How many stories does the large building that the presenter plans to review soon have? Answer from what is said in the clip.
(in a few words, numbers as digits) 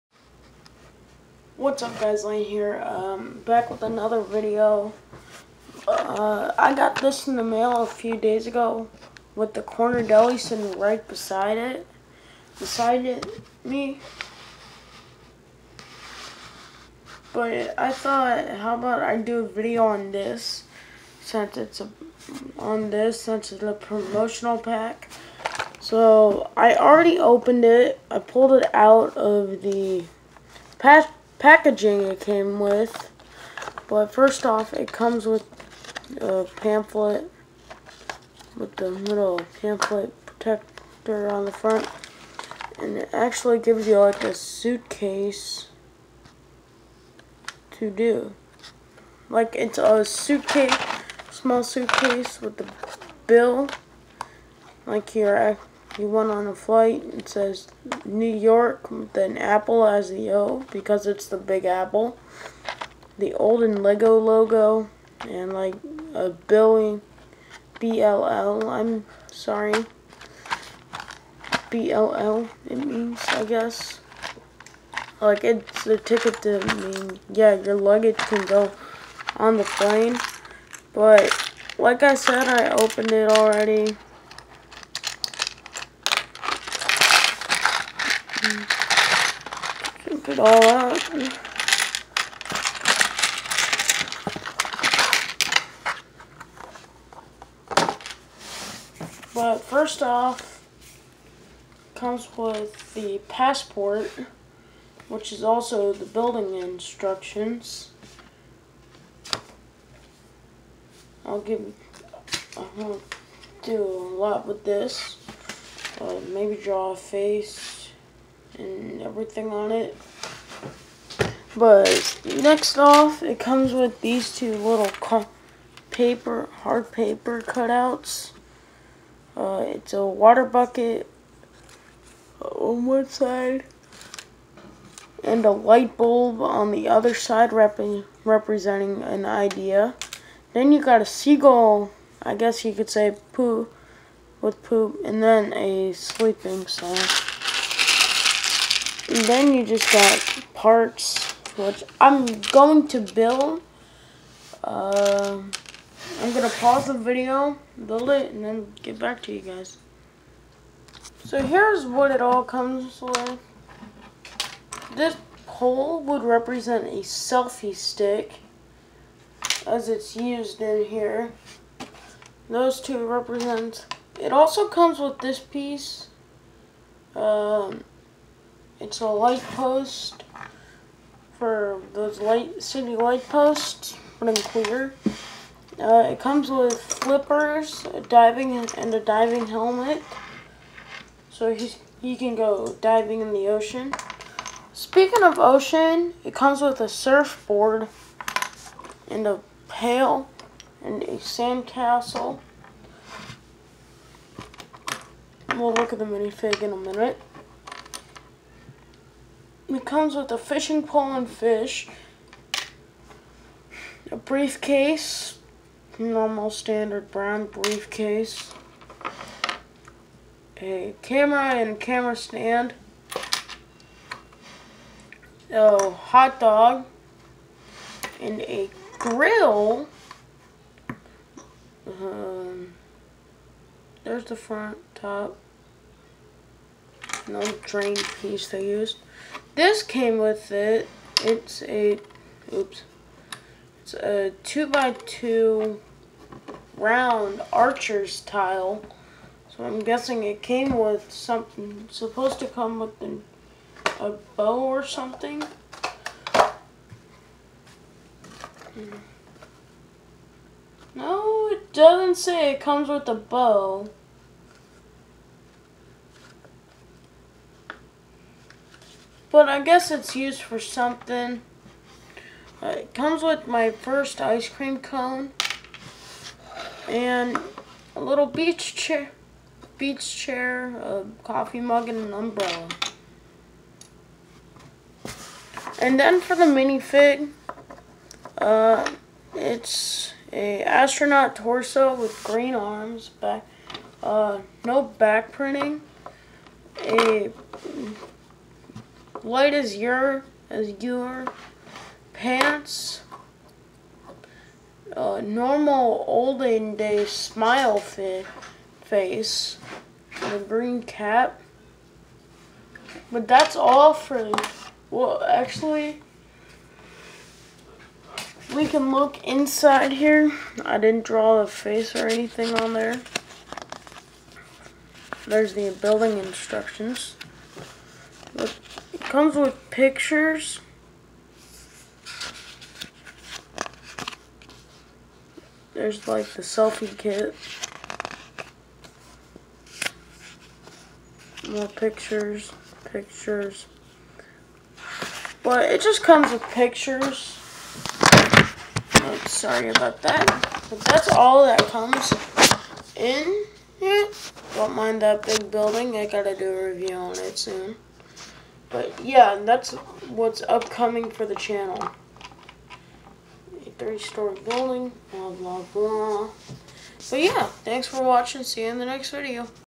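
3.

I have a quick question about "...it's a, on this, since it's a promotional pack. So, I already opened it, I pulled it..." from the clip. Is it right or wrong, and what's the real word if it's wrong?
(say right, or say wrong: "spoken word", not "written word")
right.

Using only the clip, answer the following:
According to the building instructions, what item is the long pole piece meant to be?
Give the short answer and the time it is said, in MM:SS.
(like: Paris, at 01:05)
selfie stick, at 02:47.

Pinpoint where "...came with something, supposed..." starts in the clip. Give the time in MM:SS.
04:10.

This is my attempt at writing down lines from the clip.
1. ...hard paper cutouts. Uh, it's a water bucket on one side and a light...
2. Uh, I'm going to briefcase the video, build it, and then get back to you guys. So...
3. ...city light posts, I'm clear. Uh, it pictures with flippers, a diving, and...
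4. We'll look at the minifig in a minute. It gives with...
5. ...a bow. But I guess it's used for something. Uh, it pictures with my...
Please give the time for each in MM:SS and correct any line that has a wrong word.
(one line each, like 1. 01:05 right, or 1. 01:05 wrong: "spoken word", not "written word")
1. 02:06 right
2. 02:34 wrong: "pause", not "briefcase"
3. 03:02 wrong: "comes", not "pictures"
4. 03:25 wrong: "comes", not "gives"
5. 04:23 wrong: "comes", not "pictures".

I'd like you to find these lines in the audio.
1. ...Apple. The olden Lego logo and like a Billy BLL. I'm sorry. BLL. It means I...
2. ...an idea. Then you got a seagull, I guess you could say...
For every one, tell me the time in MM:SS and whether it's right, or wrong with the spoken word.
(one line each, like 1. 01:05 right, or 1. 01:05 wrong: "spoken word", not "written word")
1. 01:01 right
2. 02:19 right.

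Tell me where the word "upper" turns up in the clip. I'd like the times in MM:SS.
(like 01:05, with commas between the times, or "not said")
not said.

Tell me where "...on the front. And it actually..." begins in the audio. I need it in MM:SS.
00:41.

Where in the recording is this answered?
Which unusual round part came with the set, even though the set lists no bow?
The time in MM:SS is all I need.
04:04.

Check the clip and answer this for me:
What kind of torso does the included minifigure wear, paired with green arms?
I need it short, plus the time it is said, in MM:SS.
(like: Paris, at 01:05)
astronaut torso, at 04:50.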